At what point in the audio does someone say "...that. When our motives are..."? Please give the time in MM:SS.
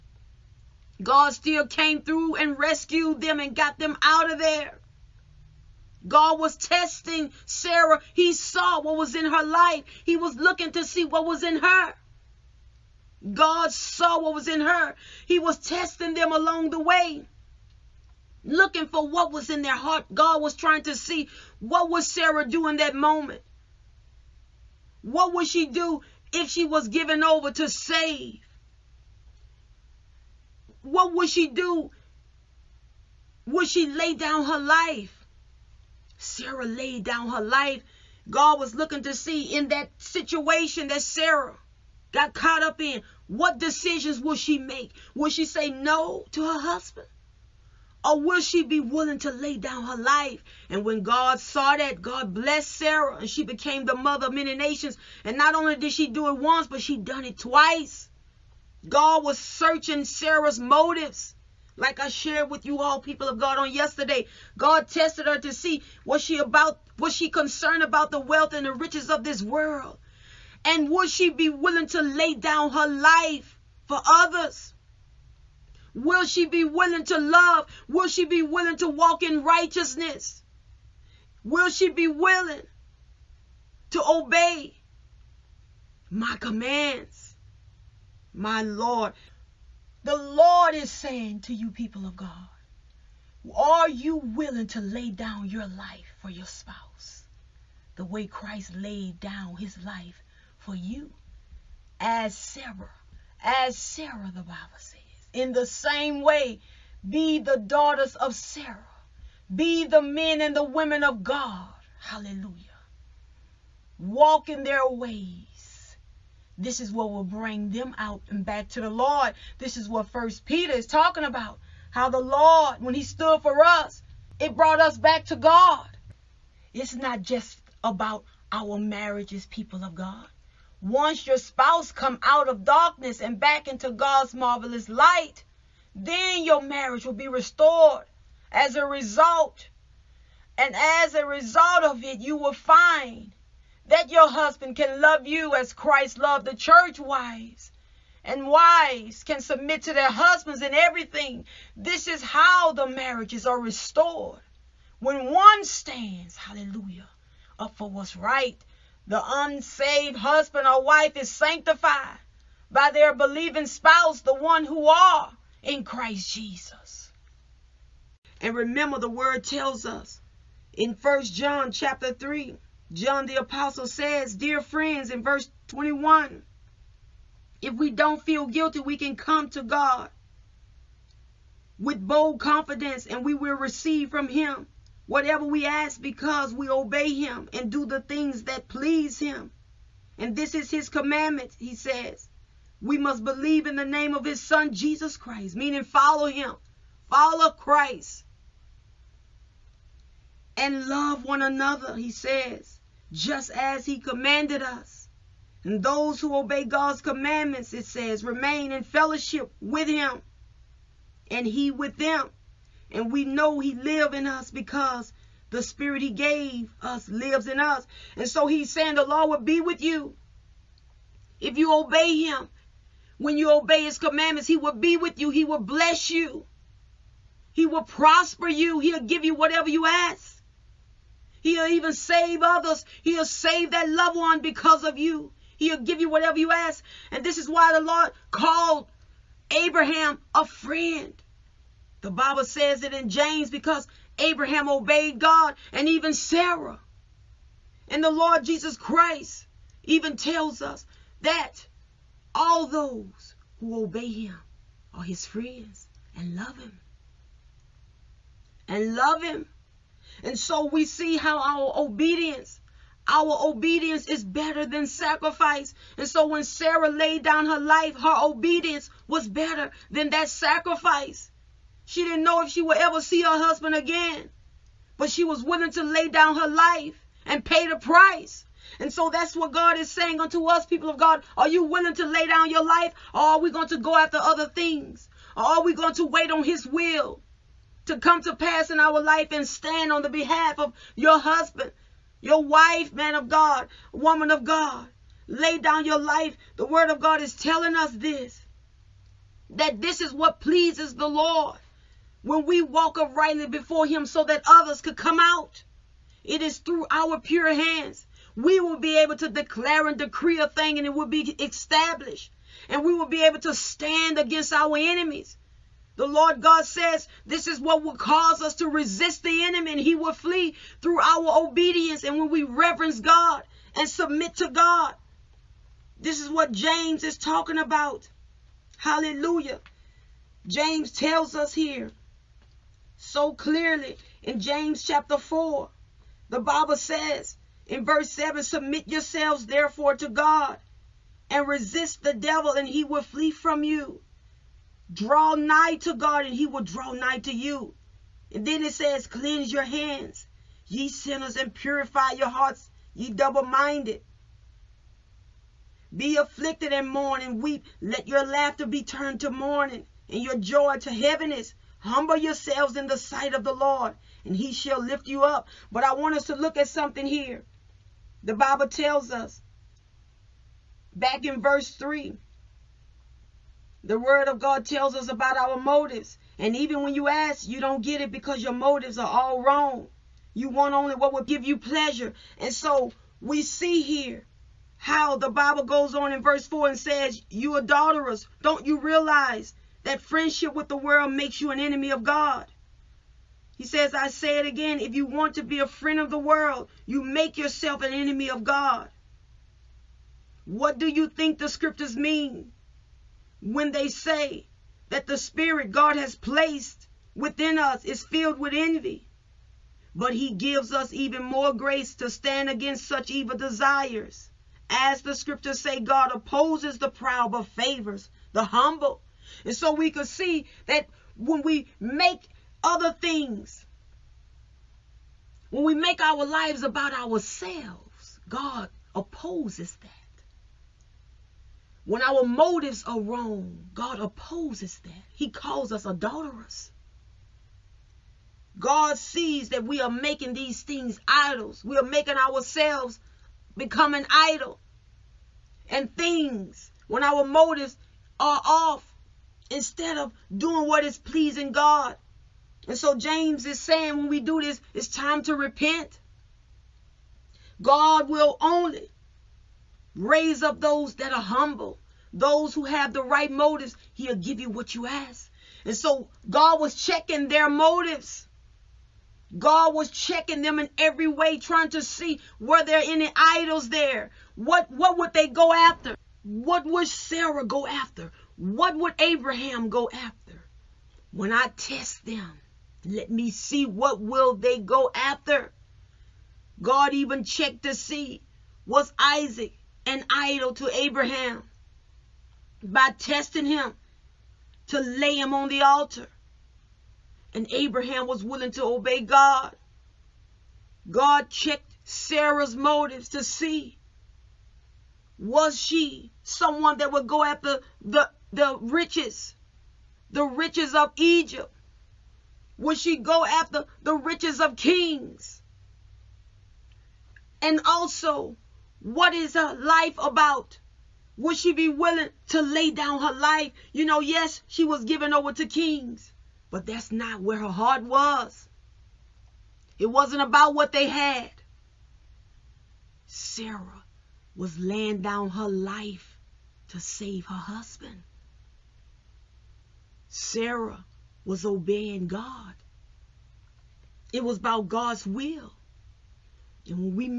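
07:09.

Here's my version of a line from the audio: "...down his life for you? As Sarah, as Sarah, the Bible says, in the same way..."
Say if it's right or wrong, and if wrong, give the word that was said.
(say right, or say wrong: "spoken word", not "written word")
right.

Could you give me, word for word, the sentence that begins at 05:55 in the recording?
Be afflicted and mourn and weep.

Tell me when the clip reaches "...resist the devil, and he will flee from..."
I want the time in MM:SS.
05:41.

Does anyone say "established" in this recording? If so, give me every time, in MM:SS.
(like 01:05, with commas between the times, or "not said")
05:11.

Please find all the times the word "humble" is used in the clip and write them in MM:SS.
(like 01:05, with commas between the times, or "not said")
06:01, 06:58, 07:41.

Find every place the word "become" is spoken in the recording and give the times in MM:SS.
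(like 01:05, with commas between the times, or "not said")
07:23.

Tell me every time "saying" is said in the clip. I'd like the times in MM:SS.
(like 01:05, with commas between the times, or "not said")
01:30, 03:38, 04:39, 07:33.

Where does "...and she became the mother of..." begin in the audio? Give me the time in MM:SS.
00:53.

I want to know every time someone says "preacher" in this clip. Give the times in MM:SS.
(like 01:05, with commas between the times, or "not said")
not said.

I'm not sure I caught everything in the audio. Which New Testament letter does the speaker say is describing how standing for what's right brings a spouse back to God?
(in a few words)
First Peter.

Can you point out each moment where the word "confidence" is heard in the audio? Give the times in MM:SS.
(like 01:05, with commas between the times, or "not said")
03:02.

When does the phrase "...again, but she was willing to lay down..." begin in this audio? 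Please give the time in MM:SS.
04:33.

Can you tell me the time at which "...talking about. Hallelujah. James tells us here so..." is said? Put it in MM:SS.
05:27.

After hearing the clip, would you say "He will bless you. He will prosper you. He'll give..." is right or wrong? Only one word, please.
right.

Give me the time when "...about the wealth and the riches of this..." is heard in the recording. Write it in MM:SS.
01:07.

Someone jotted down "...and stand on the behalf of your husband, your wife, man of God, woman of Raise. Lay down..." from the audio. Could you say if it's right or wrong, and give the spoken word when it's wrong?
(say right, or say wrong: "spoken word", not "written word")
wrong: "God", not "Raise".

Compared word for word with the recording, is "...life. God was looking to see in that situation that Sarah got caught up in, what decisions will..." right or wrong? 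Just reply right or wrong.
right.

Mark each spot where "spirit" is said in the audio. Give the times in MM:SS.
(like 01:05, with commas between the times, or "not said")
03:35, 06:45.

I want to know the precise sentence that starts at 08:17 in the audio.
And Abraham was willing to obey God.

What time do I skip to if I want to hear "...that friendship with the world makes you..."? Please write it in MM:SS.
06:29.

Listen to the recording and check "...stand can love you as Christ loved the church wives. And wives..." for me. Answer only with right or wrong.
wrong.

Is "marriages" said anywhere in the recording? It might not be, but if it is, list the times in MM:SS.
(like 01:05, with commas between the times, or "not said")
02:08, 02:16, 02:32.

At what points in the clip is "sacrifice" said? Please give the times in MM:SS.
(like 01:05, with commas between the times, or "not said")
04:24, 04:30.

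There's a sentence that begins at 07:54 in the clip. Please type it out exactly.
What what would they go after?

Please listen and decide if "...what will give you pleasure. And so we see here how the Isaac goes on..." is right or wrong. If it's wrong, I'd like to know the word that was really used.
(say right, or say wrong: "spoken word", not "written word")
wrong: "Bible", not "Isaac".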